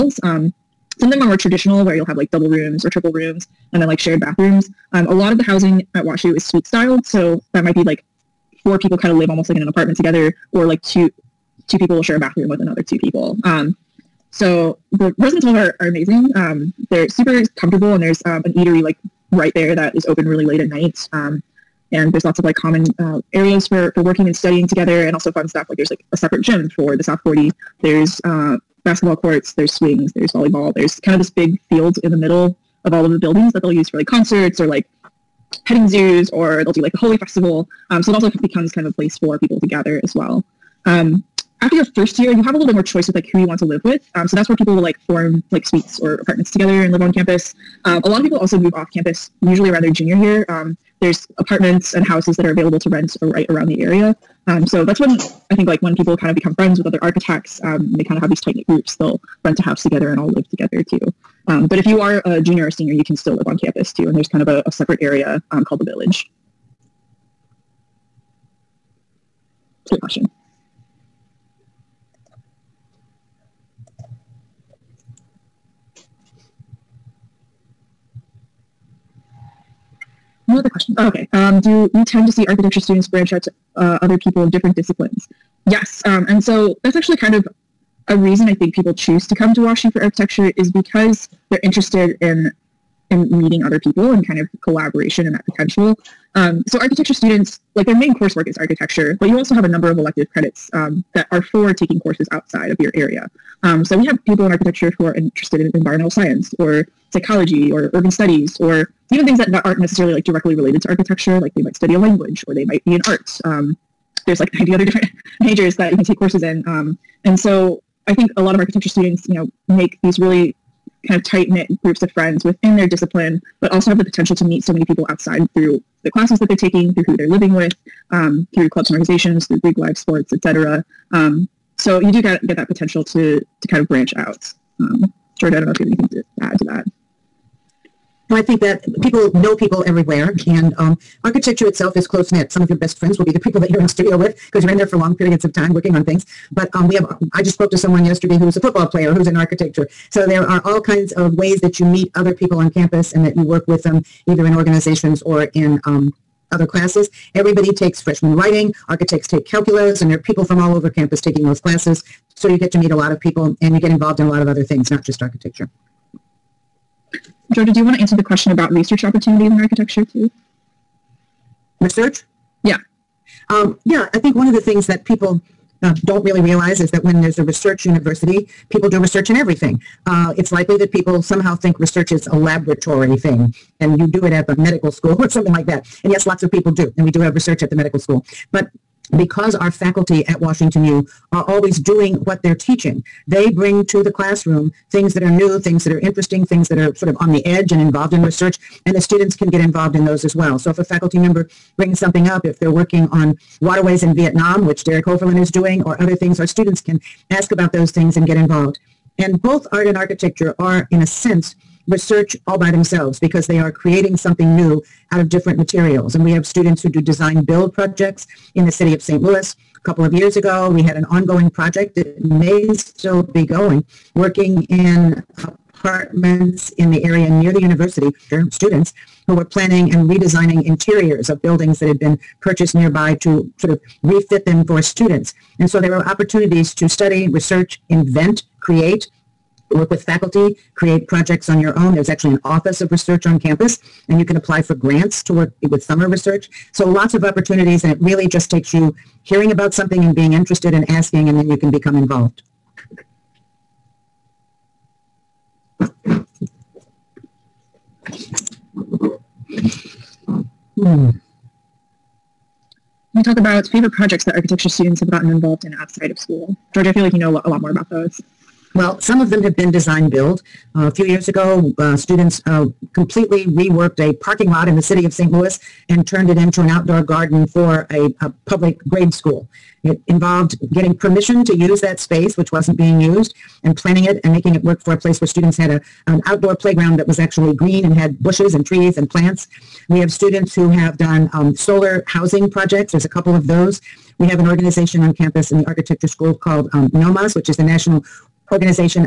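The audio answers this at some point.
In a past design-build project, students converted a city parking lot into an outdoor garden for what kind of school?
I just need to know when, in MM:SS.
04:38.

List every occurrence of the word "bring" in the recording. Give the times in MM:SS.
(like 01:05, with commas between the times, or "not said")
03:13, 03:21.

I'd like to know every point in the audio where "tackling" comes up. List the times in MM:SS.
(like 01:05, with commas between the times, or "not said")
not said.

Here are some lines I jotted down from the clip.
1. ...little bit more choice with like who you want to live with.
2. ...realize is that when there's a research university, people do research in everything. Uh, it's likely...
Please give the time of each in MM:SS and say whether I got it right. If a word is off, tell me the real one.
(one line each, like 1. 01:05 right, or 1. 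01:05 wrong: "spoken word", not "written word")
1. 00:42 right
2. 02:56 right.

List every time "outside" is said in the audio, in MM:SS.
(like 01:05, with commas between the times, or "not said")
01:42, 02:05, 04:25.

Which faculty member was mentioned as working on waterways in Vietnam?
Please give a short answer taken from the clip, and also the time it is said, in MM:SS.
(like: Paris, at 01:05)
Derek Hoeferlin, at 03:24.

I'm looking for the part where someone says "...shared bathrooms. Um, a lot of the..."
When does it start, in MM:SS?
00:03.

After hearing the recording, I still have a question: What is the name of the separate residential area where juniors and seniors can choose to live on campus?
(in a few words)
the Village.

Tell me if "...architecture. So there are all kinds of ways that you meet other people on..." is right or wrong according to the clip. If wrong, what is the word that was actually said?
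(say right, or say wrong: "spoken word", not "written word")
right.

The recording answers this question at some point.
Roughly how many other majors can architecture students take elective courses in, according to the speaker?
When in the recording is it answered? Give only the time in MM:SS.
01:54.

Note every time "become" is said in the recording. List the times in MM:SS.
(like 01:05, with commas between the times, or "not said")
00:38, 00:56, 04:11.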